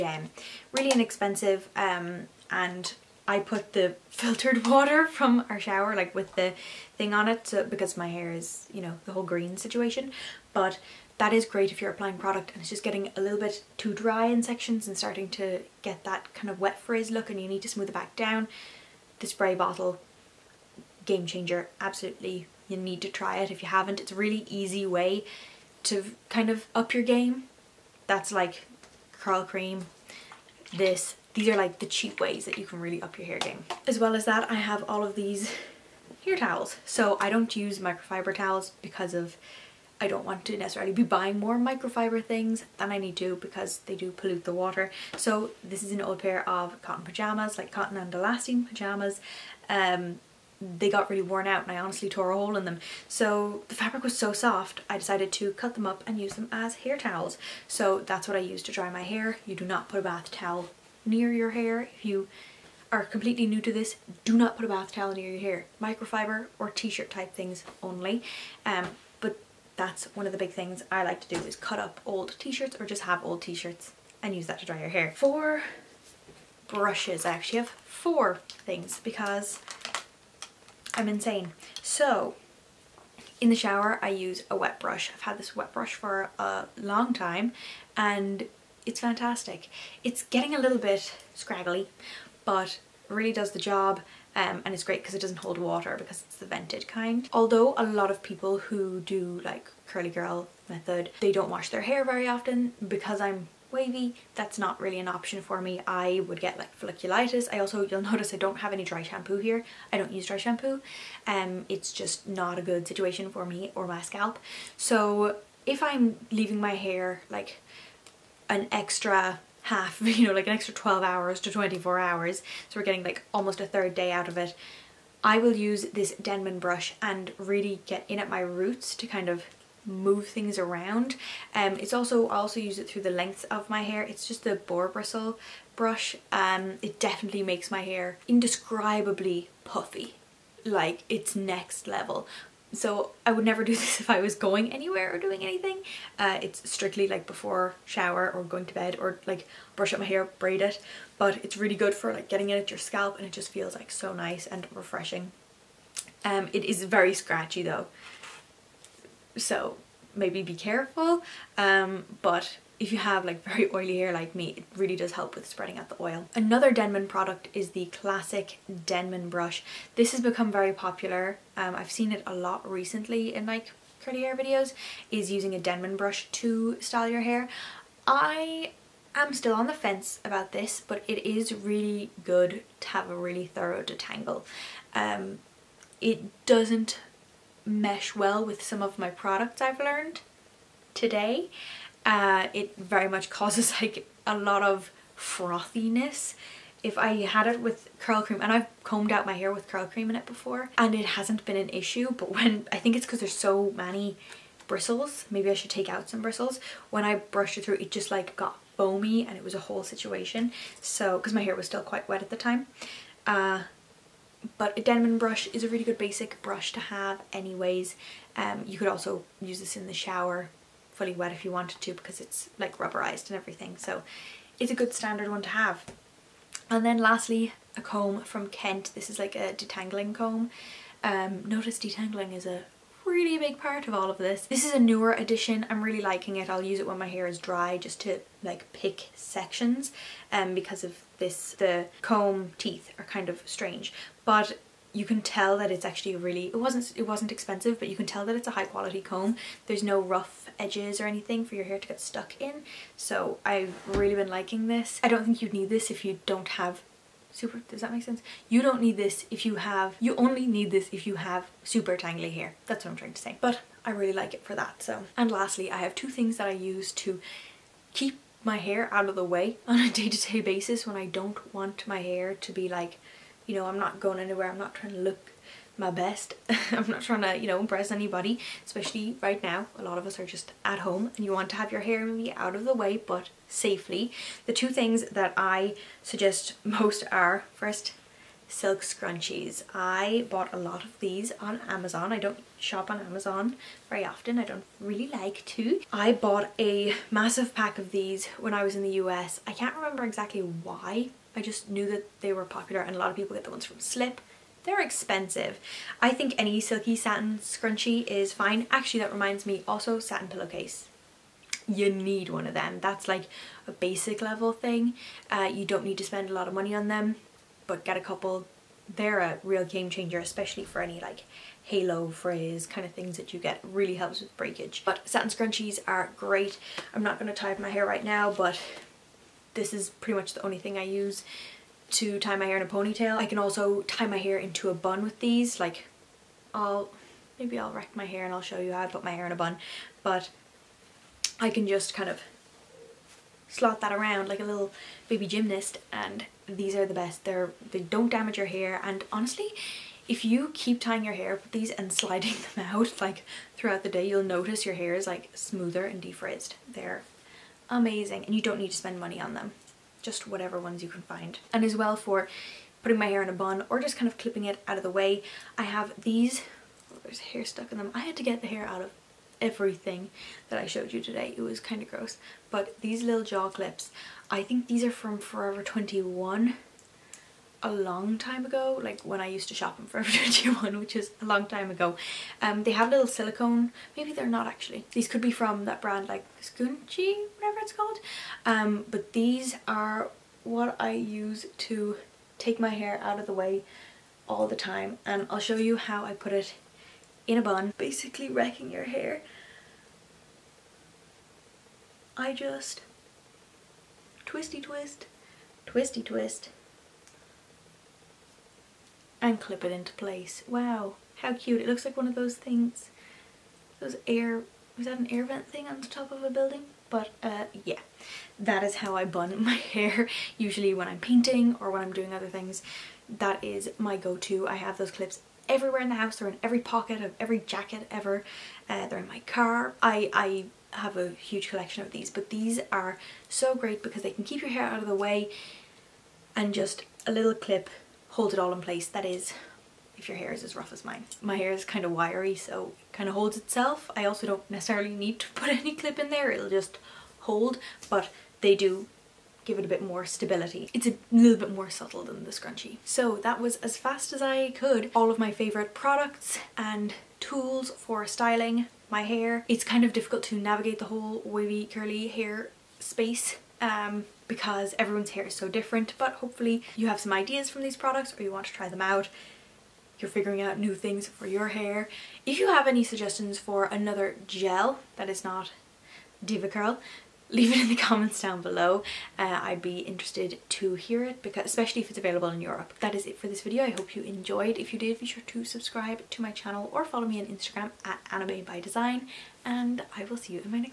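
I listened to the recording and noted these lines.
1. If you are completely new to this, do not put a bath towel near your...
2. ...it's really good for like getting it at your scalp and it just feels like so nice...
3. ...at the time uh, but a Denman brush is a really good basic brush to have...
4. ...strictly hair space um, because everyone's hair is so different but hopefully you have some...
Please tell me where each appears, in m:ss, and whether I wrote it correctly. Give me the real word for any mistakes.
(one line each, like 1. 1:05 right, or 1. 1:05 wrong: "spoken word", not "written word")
1. 1:01 right
2. 2:31 right
3. 3:32 right
4. 7:41 wrong: "curly", not "strictly".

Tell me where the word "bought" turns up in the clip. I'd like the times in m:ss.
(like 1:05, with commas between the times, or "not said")
4:50, 4:56.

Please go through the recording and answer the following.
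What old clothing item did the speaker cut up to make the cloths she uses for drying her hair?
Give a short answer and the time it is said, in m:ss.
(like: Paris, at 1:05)
Cotton pajamas, at 0:46.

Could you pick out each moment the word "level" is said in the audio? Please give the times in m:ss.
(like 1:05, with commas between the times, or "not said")
2:21, 5:14.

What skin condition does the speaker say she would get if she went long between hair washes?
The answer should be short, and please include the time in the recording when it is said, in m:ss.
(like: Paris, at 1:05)
Folliculitis, at 1:46.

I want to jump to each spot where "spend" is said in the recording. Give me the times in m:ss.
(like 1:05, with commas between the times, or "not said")
5:16, 5:58.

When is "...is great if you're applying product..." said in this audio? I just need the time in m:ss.
0:11.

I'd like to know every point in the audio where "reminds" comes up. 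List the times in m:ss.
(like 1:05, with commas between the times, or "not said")
5:09.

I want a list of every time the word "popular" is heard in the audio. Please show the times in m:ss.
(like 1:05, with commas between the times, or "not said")
2:50, 5:02.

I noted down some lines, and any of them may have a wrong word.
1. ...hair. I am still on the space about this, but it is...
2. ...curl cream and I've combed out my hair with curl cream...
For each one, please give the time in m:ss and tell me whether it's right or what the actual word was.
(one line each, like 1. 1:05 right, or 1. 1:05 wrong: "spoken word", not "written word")
1. 2:57 wrong: "fence", not "space"
2. 3:17 right.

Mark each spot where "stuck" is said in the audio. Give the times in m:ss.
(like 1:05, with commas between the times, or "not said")
4:11, 6:07.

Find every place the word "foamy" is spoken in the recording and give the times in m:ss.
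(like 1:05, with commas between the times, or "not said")
3:28.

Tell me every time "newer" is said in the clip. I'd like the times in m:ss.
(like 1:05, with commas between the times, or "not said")
3:54.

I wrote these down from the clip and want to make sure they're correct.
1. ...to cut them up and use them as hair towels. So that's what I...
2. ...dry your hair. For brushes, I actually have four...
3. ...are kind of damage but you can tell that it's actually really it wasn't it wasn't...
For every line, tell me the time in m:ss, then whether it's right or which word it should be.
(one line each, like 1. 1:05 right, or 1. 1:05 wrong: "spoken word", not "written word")
1. 0:55 right
2. 1:14 right
3. 4:02 wrong: "strange", not "damage".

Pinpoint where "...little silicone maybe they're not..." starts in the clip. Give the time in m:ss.
6:22.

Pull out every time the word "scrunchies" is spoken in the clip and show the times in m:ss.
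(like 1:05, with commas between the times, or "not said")
4:48, 5:07, 5:25, 7:32.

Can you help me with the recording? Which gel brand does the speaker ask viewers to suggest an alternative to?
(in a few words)
DevaCurl.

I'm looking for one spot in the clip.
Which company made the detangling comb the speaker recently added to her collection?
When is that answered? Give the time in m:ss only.
3:48.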